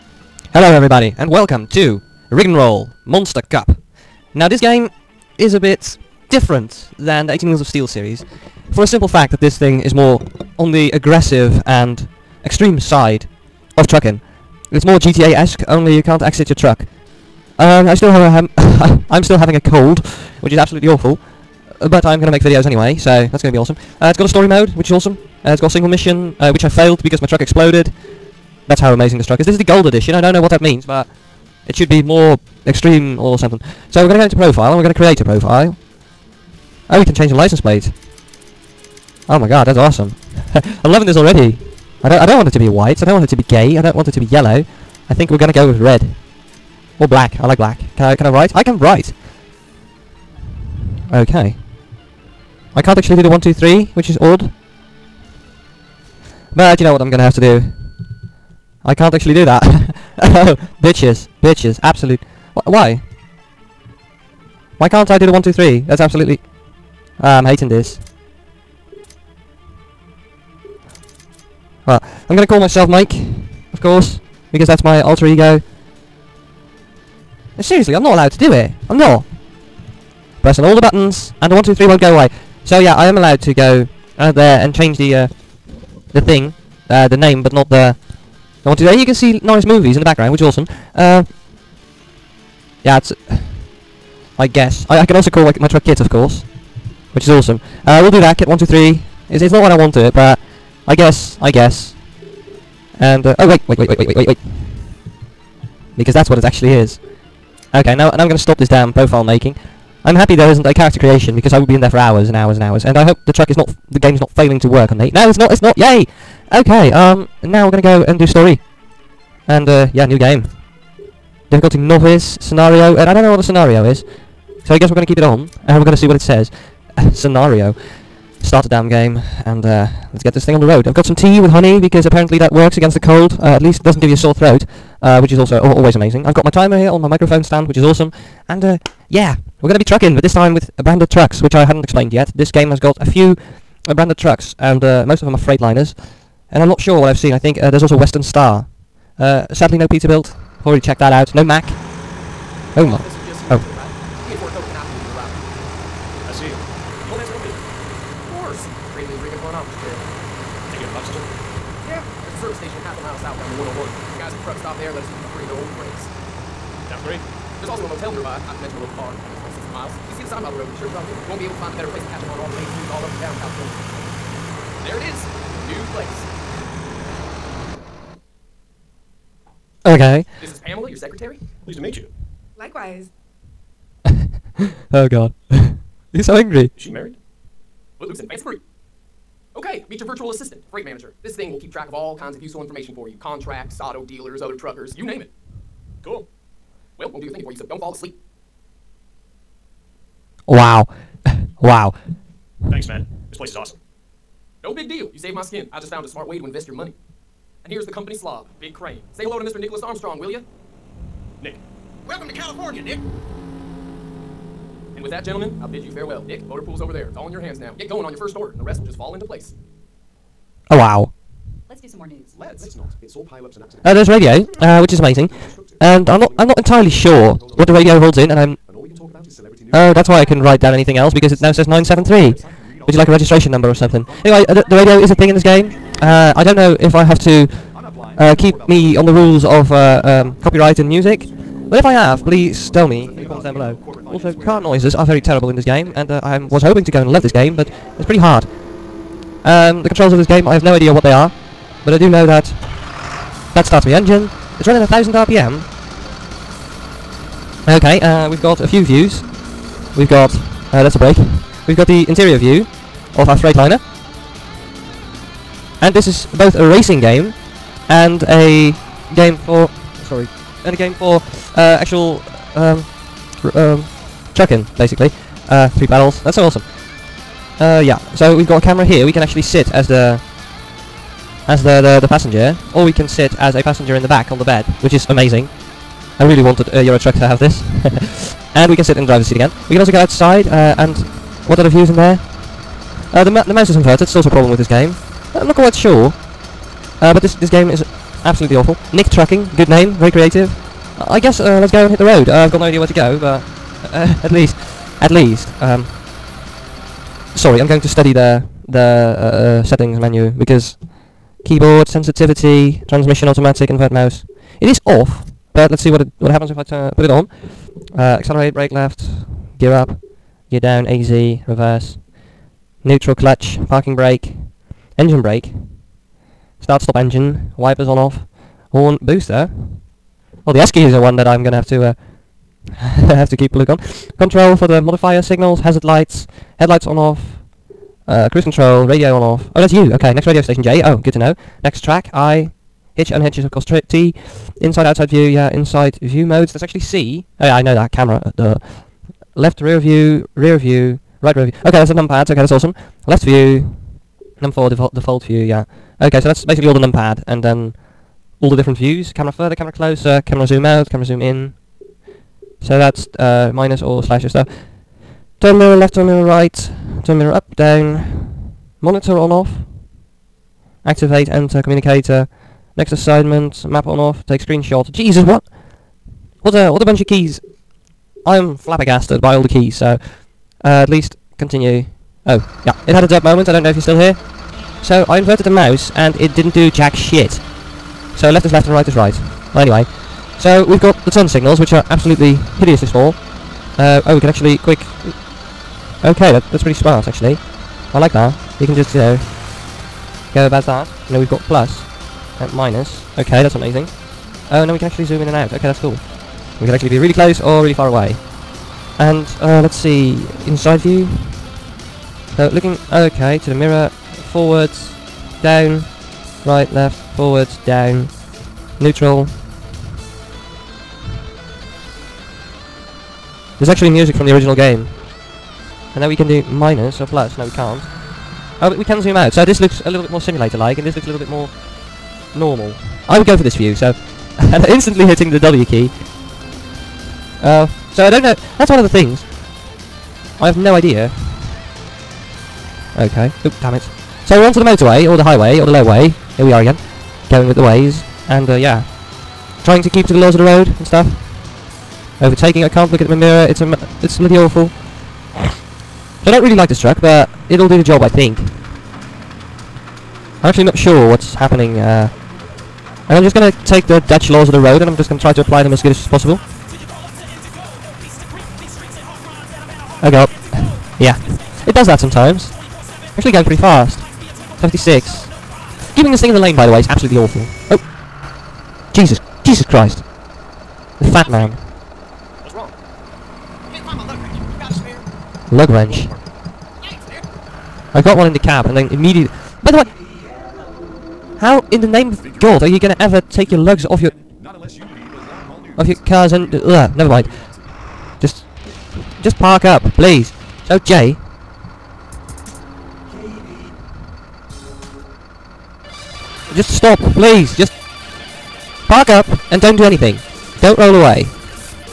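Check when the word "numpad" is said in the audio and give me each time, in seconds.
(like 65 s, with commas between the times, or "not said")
351 s, 356 s.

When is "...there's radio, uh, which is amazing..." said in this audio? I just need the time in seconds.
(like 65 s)
223 s.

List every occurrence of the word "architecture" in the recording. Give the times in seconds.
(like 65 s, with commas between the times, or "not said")
not said.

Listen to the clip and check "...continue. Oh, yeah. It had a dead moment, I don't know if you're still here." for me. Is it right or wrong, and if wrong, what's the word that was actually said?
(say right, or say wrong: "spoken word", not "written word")
right.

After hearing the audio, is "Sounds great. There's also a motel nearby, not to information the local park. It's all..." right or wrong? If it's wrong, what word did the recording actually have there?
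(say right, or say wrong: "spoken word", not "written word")
wrong: "mention", not "information".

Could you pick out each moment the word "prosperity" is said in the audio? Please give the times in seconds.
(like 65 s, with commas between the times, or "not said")
not said.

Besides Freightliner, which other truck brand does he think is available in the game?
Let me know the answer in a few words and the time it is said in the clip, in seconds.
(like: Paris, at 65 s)
Western Star, at 147 s.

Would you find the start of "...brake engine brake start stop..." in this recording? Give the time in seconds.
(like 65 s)
323 s.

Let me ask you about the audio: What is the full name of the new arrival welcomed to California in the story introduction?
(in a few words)
Nicholas Armstrong.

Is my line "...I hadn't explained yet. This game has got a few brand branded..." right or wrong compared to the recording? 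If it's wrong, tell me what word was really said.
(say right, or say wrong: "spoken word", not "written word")
right.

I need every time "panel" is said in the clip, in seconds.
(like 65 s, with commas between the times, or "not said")
not said.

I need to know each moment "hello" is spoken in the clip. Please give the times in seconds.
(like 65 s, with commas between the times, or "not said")
0 s, 209 s.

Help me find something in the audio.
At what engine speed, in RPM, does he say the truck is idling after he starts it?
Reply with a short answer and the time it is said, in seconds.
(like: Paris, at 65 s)
1000, at 254 s.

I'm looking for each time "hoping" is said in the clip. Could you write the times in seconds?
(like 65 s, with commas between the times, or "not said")
246 s.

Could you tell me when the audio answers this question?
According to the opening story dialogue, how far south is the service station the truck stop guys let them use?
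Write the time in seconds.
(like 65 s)
162 s.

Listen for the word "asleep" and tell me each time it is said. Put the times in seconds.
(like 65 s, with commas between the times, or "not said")
197 s.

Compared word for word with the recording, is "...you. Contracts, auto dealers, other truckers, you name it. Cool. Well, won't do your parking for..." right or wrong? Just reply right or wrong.
wrong.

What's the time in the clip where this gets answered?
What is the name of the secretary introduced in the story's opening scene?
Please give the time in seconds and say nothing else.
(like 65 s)
180 s.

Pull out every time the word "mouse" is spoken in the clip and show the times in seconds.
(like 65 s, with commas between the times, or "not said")
293 s, 313 s, 385 s.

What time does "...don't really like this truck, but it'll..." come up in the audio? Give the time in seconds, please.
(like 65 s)
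456 s.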